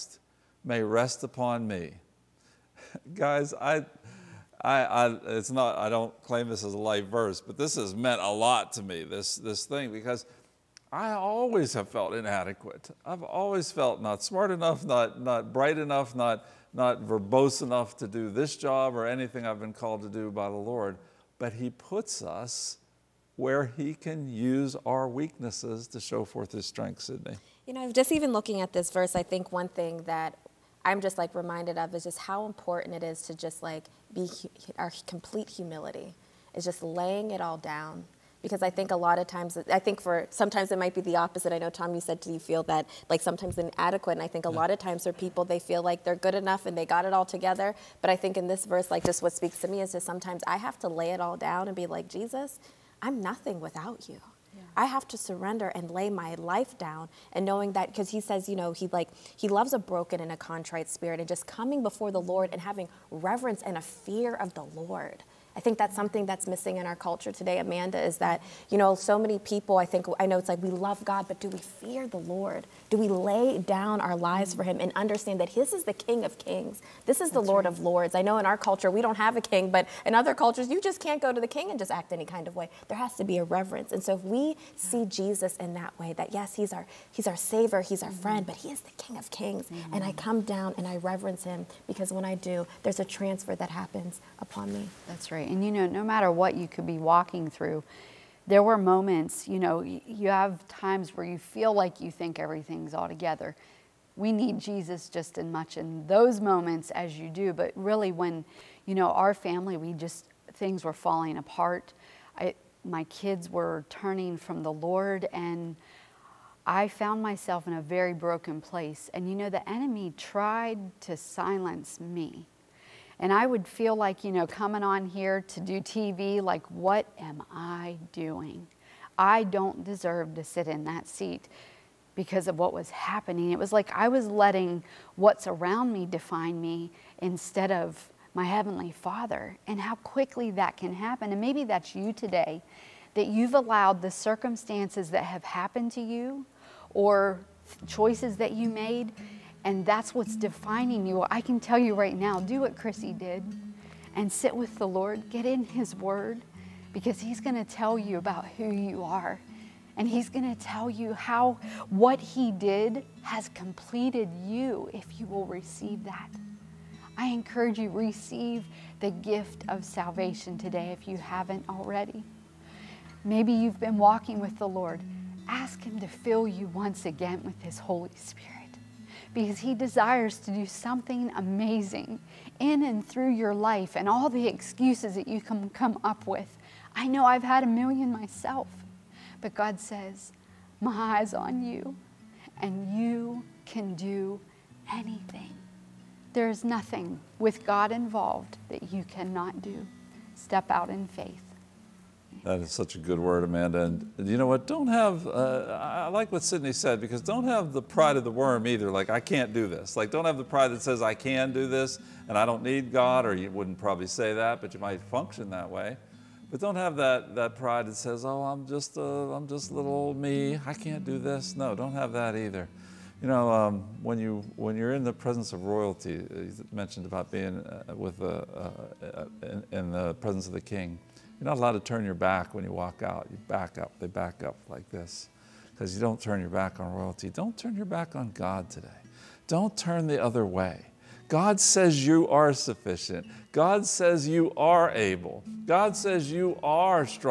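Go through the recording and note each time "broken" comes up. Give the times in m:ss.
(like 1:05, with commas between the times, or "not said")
0:59, 1:58.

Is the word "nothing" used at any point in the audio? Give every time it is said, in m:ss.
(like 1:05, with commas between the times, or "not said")
0:53, 3:16.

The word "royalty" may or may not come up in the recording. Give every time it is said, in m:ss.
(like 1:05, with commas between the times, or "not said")
3:45, 3:56.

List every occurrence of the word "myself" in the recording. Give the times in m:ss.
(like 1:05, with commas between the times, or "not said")
1:57, 3:08.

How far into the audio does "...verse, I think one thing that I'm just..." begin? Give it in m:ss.
0:28.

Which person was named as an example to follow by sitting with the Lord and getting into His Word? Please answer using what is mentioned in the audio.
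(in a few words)
Krissy.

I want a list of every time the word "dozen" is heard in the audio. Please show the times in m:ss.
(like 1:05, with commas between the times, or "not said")
not said.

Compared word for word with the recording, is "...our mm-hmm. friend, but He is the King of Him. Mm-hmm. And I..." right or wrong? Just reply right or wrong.
wrong.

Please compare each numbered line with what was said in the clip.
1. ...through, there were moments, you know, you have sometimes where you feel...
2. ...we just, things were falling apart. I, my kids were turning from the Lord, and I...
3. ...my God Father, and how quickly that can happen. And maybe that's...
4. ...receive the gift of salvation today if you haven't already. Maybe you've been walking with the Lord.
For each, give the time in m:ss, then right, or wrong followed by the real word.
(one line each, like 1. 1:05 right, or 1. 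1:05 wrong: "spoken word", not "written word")
1. 1:37 wrong: "times", not "sometimes"
2. 1:49 right
3. 2:18 wrong: "Heavenly", not "God"
4. 2:47 right.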